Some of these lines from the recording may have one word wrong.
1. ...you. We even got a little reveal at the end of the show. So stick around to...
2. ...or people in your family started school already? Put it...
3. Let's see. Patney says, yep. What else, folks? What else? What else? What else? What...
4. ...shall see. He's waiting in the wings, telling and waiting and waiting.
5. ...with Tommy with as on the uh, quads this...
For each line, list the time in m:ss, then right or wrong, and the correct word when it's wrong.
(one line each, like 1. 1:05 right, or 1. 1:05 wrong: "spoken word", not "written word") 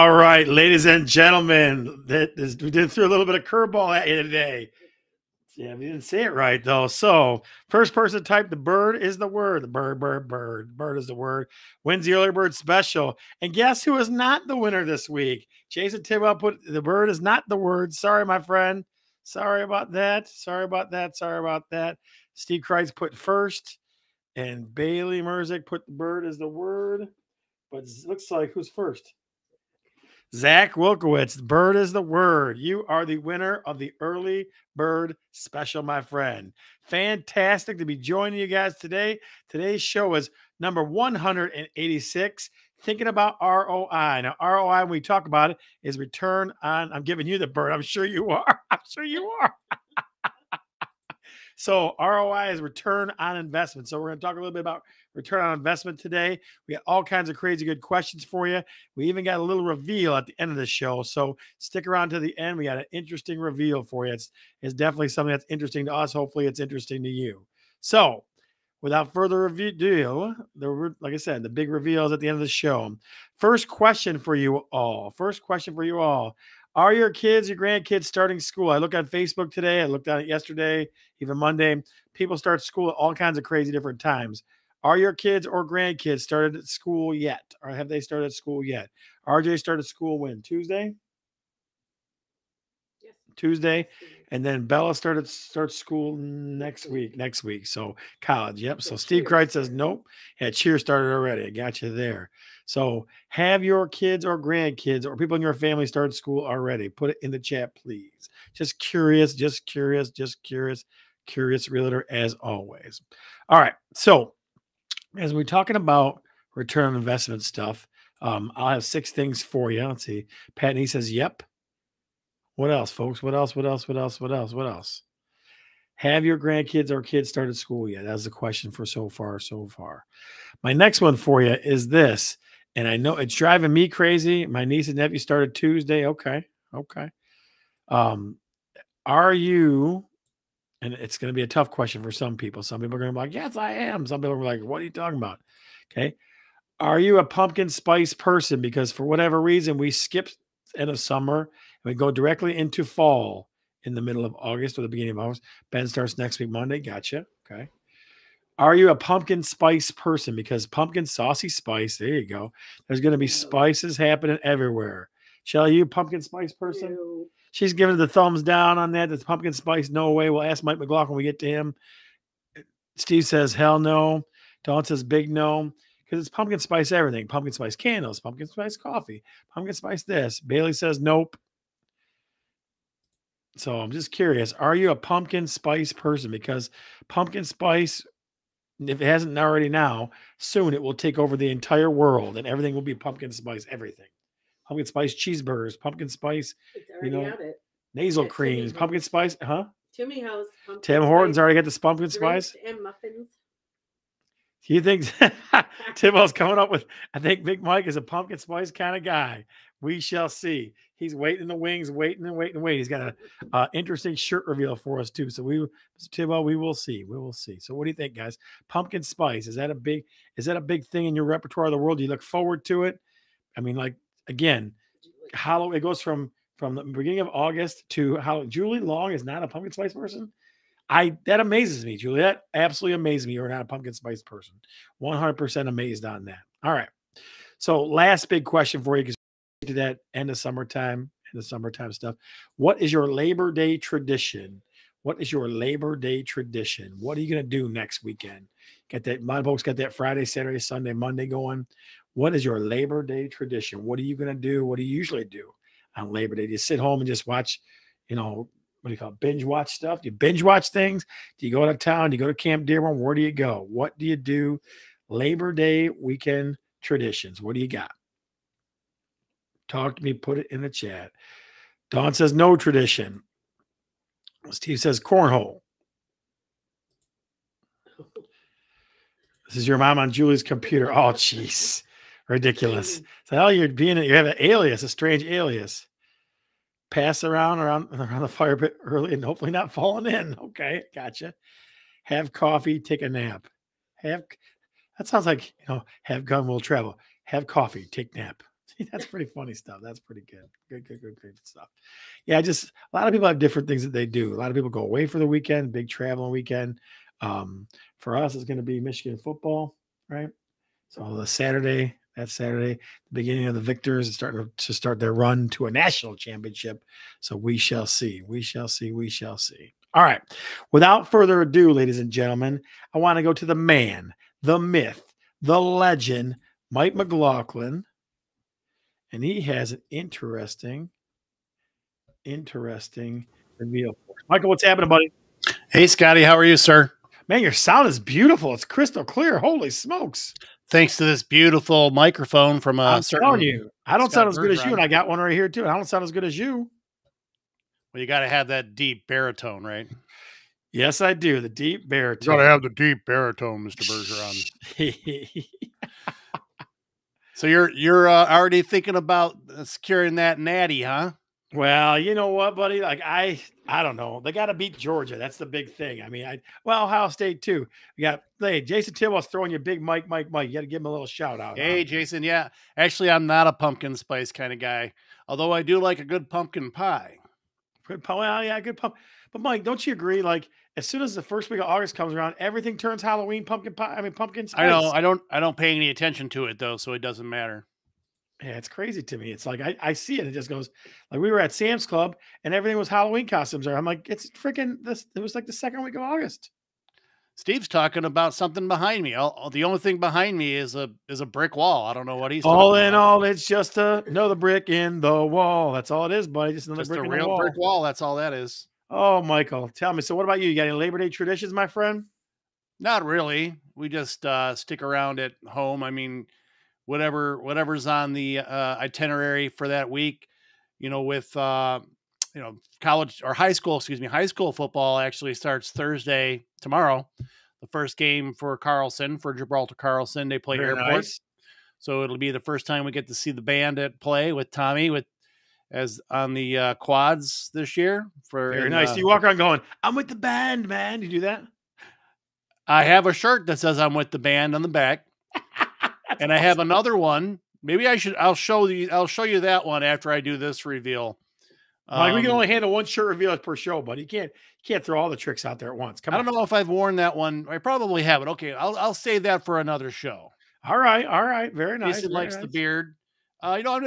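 1. 0:58 right
2. 1:45 right
3. 1:59 right
4. 3:29 wrong: "waiting", not "telling"
5. 7:14 right.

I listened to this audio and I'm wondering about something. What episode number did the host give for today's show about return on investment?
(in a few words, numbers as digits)
186.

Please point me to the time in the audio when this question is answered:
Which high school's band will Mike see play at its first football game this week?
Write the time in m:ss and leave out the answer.
7:09.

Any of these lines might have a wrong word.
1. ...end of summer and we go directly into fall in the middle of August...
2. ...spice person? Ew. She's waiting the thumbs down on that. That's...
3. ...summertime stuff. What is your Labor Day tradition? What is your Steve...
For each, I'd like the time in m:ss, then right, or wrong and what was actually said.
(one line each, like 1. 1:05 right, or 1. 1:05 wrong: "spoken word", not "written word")
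1. 2:30 right
2. 2:46 wrong: "giving", not "waiting"
3. 4:01 wrong: "Labor", not "Steve".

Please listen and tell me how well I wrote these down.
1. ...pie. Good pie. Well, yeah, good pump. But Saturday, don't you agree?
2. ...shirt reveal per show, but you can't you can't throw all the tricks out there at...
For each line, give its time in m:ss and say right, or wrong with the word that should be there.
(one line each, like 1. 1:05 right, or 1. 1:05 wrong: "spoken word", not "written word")
1. 6:16 wrong: "Mike", not "Saturday"
2. 7:32 right.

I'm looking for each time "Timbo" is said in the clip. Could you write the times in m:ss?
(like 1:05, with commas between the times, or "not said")
3:25, 3:36.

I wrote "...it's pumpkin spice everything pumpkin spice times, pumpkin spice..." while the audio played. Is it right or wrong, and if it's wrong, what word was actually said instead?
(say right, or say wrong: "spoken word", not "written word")
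wrong: "candles", not "times".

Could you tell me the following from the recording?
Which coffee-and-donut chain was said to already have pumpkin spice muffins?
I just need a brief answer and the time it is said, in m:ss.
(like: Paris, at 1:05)
Tim Hortons, at 3:20.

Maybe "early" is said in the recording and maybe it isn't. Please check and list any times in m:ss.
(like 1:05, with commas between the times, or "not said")
0:12, 0:33, 4:48.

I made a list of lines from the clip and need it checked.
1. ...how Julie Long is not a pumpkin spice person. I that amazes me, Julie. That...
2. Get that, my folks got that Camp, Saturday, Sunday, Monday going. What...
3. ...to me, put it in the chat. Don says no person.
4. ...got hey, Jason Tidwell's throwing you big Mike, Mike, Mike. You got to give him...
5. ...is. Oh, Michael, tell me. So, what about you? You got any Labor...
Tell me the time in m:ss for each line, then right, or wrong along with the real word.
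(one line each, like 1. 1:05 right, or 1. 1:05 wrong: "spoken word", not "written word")
1. 3:48 right
2. 4:08 wrong: "Friday", not "Camp"
3. 4:29 wrong: "tradition", not "person"
4. 6:08 right
5. 6:48 right.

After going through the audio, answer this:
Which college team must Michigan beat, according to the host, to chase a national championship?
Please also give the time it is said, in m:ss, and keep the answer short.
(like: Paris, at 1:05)
Georgia, at 6:04.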